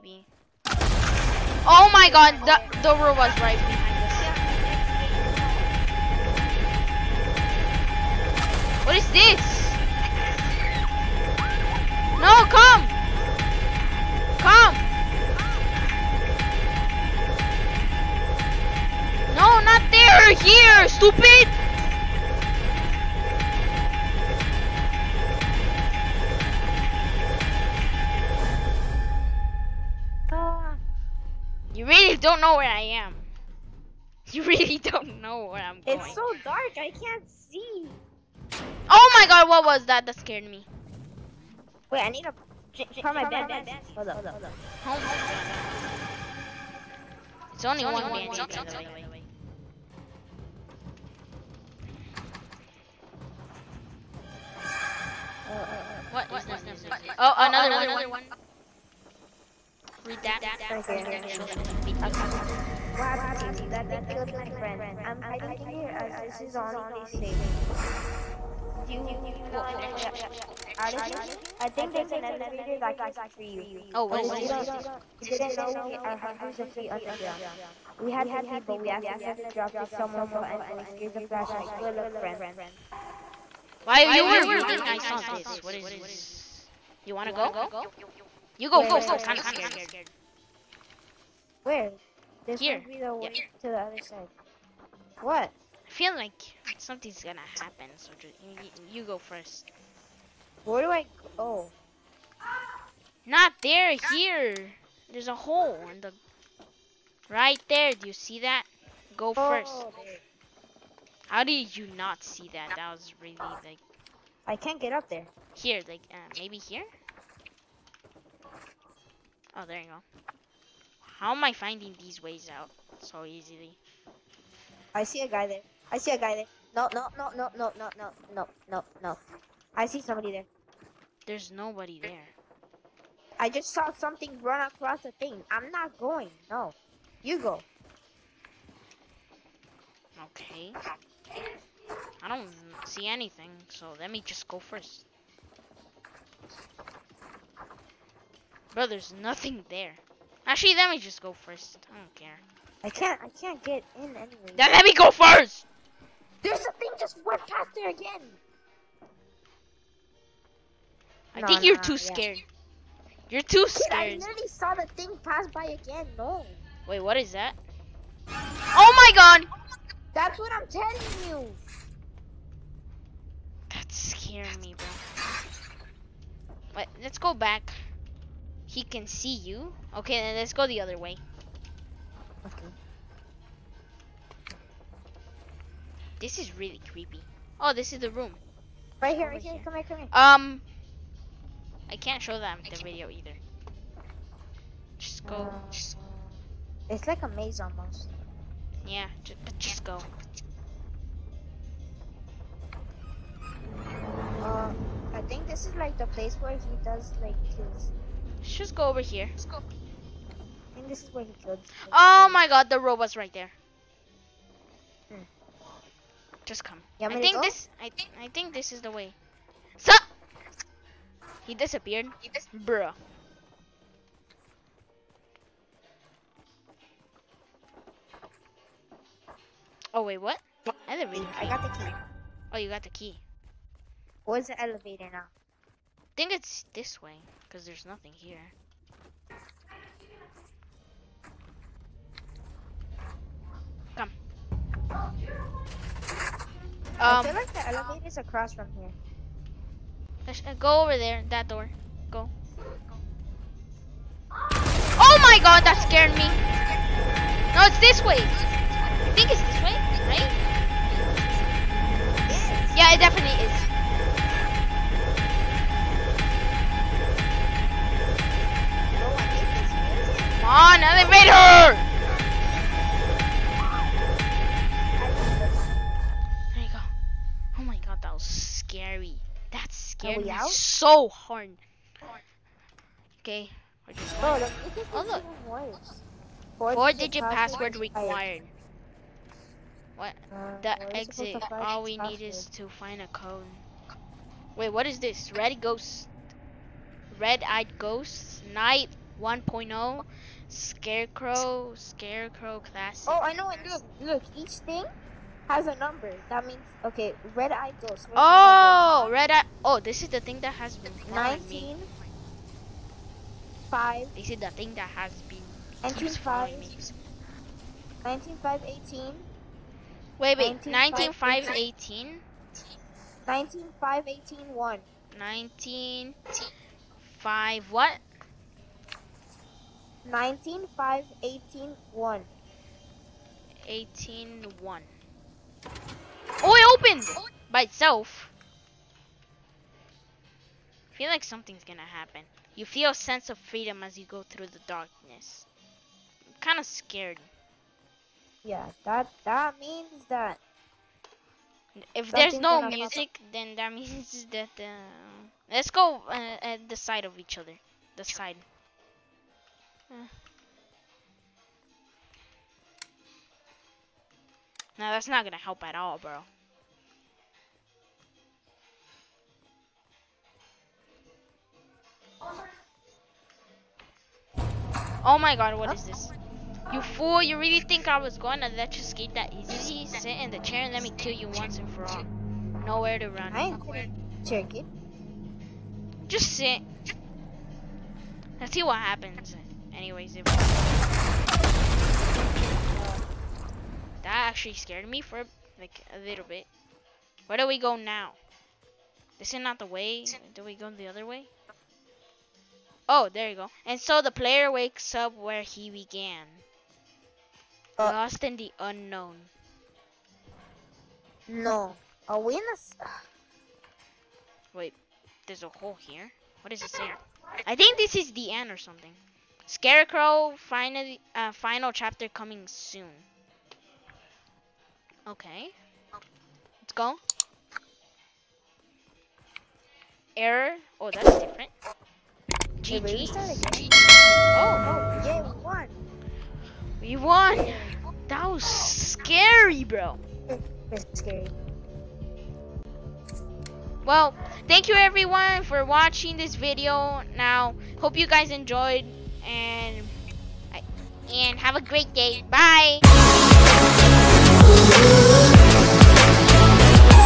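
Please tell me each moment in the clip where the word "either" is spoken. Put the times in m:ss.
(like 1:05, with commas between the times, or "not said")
3:13.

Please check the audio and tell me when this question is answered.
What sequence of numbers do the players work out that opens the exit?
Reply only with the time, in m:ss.
5:30.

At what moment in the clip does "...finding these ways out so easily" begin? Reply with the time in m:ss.
2:01.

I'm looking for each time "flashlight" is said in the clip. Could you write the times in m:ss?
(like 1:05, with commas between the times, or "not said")
1:21.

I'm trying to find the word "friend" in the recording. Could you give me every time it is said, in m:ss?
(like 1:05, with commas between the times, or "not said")
1:04, 1:22.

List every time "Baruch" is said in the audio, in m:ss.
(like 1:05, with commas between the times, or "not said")
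not said.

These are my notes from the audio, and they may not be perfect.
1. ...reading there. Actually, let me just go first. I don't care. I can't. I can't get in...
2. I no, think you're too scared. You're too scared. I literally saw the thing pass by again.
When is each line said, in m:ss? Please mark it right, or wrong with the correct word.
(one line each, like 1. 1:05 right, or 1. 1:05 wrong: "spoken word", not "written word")
1. 2:29 wrong: "nothing", not "reading"
2. 2:41 right.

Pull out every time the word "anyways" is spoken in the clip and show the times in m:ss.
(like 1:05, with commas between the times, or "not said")
1:20, 2:34, 6:29.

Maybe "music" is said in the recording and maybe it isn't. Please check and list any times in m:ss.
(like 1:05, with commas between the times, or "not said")
0:56, 5:52.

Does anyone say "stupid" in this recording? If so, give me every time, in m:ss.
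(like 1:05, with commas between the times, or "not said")
0:20.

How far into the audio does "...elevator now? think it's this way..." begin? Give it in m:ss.
3:54.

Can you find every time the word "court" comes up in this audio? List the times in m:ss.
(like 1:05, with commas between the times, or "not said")
not said.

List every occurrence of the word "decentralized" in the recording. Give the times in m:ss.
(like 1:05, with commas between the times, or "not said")
not said.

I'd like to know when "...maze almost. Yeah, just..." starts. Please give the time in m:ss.
3:17.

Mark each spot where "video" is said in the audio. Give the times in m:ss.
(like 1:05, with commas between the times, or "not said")
1:01, 3:12, 7:26.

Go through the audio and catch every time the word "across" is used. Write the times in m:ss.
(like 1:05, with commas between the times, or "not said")
2:14, 4:08.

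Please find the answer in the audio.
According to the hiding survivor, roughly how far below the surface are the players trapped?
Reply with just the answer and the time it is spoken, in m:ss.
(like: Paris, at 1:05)
hundreds of feet, at 1:16.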